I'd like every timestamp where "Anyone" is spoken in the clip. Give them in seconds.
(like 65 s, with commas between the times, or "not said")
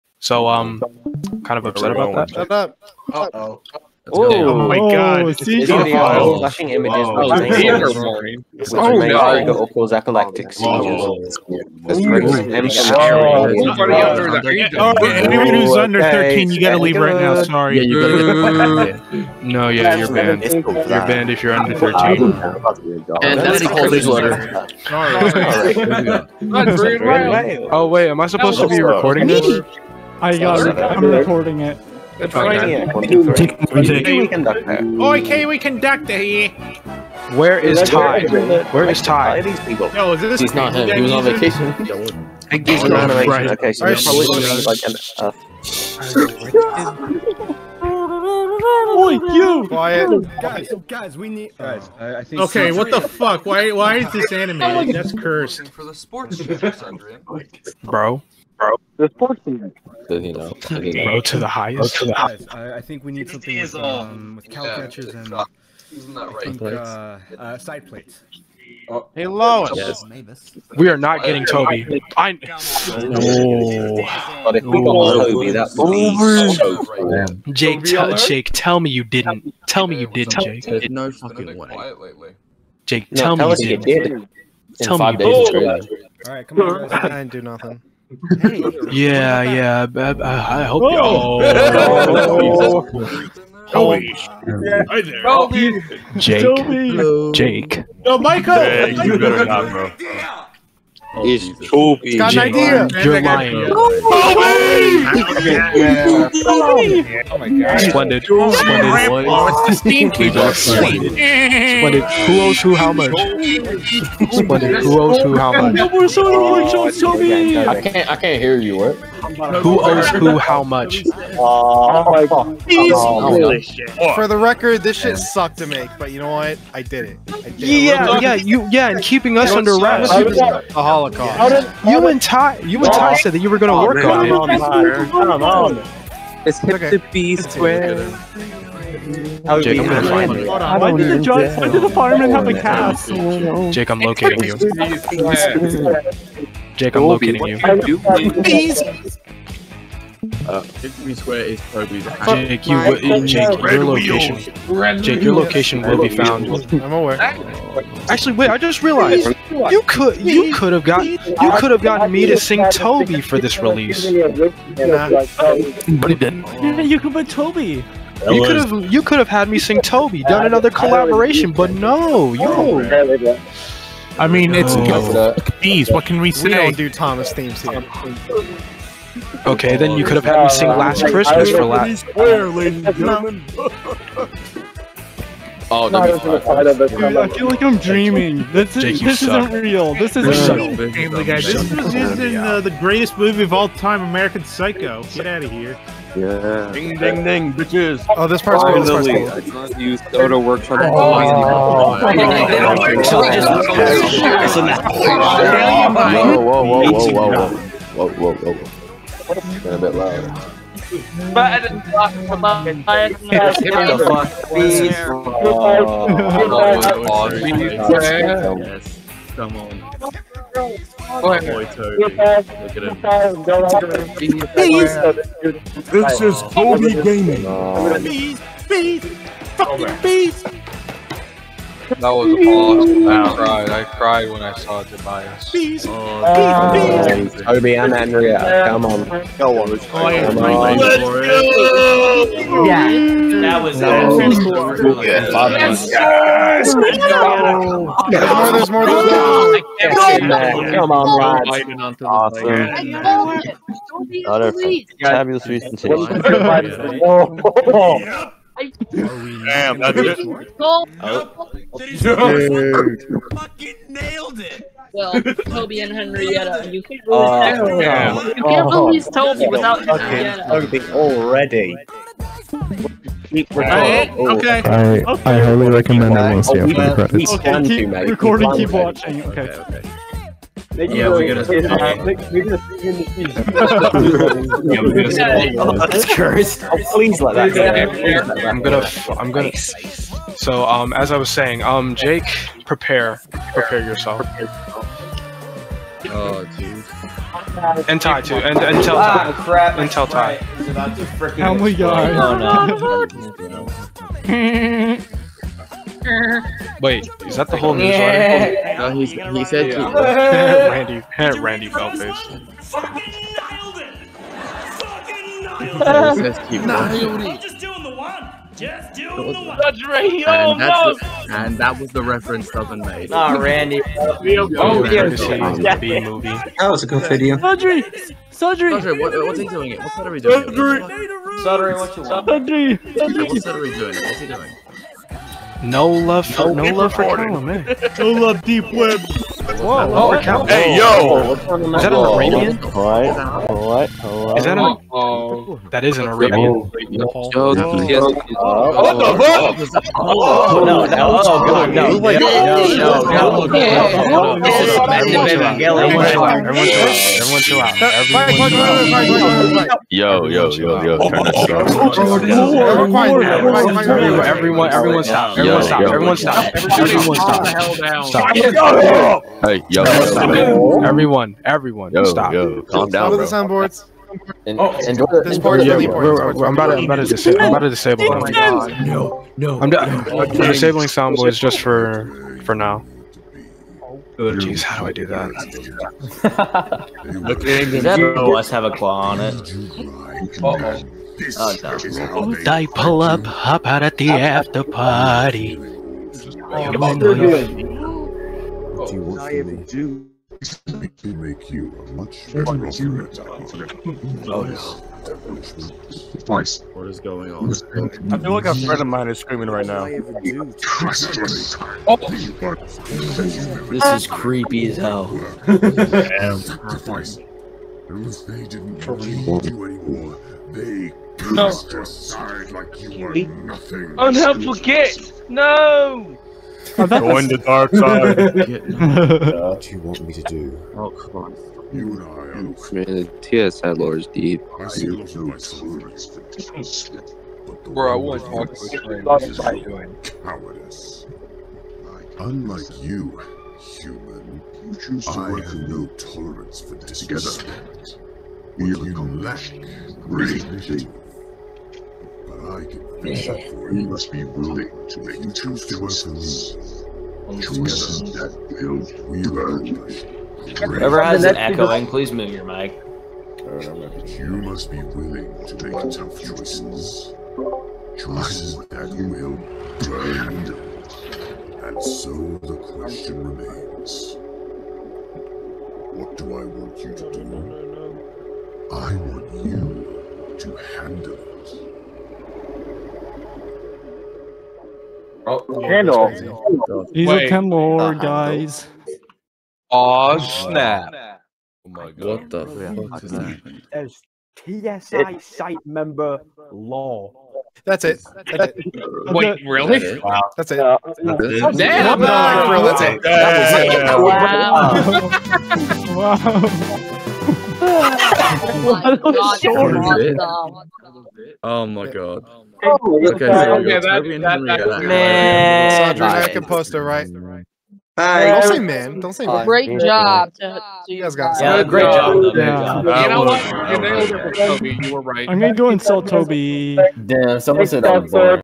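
11 s.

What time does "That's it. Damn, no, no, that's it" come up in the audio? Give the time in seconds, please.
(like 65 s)
500 s.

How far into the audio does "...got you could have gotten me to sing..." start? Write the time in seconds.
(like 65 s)
160 s.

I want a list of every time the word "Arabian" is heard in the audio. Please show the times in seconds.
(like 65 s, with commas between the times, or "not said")
342 s, 346 s.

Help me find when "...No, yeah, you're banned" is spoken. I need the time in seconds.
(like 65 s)
19 s.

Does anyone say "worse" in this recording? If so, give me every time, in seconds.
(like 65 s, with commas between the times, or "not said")
not said.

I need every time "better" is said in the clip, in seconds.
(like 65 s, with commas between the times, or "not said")
99 s, 402 s.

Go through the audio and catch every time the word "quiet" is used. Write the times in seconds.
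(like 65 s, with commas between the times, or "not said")
49 s, 363 s.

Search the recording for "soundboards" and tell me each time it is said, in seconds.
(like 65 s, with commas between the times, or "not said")
373 s, 380 s.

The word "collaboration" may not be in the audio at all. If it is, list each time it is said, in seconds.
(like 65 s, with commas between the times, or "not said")
170 s.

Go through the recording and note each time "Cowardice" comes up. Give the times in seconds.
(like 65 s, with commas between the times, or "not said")
440 s.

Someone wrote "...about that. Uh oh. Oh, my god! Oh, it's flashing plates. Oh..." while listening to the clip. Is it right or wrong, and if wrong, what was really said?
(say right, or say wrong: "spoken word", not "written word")
wrong: "images", not "plates".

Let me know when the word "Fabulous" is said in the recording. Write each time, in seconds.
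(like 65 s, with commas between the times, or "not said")
255 s.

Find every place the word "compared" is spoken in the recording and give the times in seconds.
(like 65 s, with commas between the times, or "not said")
not said.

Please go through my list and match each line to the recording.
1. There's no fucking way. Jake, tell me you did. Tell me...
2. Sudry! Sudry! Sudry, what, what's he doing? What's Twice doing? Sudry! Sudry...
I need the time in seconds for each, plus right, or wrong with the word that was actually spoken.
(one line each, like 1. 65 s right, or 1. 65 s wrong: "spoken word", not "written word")
1. 80 s right
2. 327 s wrong: "Sudry", not "Twice".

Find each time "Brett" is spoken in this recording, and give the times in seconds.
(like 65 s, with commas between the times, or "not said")
not said.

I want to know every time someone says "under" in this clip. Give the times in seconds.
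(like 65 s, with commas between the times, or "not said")
15 s, 21 s, 129 s.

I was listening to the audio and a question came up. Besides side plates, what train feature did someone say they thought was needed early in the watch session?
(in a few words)
cow catchers.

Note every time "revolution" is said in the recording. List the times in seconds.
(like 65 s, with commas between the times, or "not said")
not said.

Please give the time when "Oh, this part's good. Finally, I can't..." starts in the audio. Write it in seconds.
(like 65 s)
198 s.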